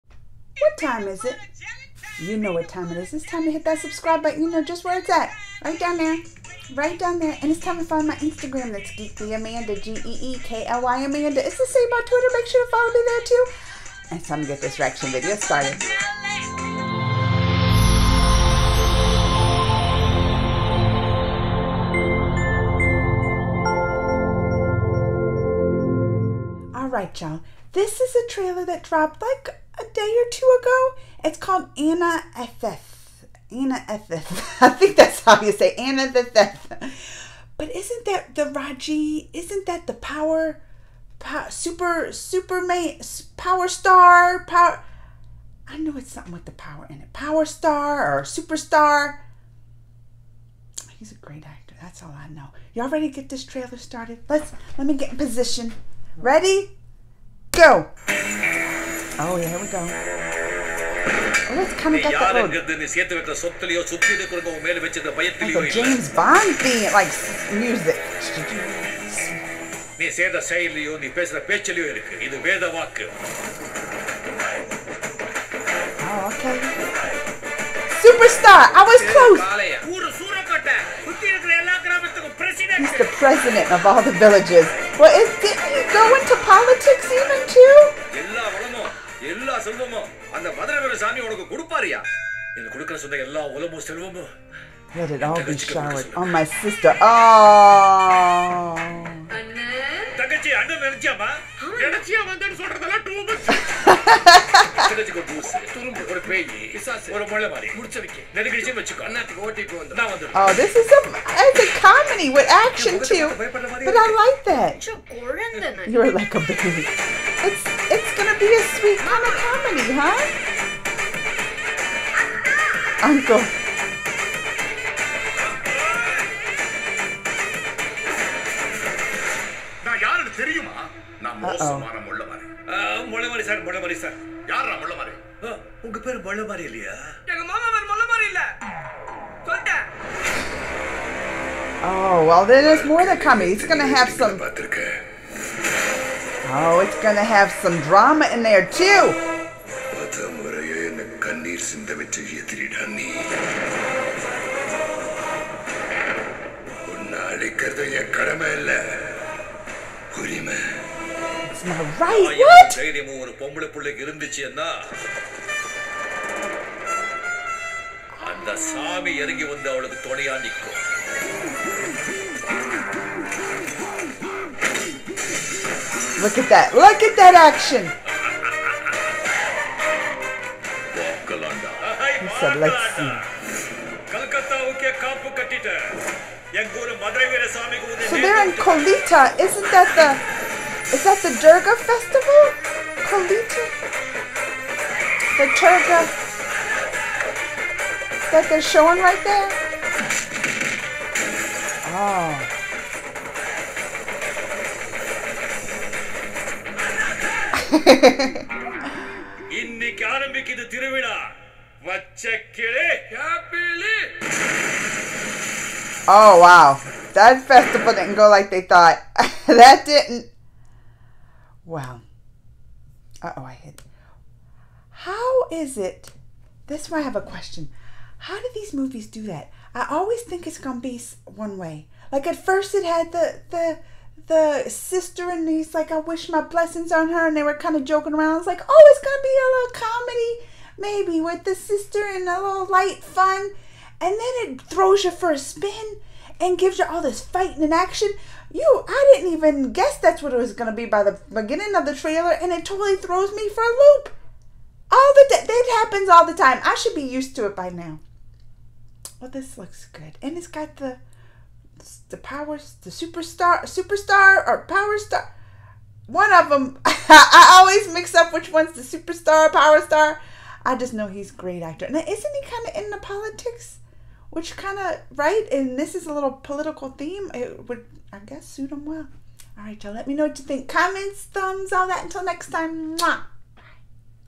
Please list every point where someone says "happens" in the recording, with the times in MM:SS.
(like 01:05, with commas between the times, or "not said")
04:15.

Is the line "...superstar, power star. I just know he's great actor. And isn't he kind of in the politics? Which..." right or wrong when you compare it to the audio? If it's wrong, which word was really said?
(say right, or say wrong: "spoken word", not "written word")
right.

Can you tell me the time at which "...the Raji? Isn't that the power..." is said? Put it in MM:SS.
00:38.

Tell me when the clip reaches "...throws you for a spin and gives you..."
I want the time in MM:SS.
04:04.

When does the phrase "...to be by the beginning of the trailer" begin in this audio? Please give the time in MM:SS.
04:10.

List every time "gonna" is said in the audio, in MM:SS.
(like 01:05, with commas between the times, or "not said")
02:27.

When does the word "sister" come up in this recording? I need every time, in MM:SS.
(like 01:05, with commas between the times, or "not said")
01:36, 03:54, 04:01.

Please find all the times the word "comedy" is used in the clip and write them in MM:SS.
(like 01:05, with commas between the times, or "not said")
01:51, 04:01.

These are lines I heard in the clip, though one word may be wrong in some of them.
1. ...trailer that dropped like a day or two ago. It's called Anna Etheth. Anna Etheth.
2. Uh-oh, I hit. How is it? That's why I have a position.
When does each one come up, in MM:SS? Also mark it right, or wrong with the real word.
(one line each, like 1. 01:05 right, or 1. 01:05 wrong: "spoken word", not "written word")
1. 00:28 right
2. 03:43 wrong: "question", not "position".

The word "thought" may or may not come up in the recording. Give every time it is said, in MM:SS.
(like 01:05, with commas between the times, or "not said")
03:38.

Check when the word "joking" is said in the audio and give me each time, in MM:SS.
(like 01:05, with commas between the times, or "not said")
03:57.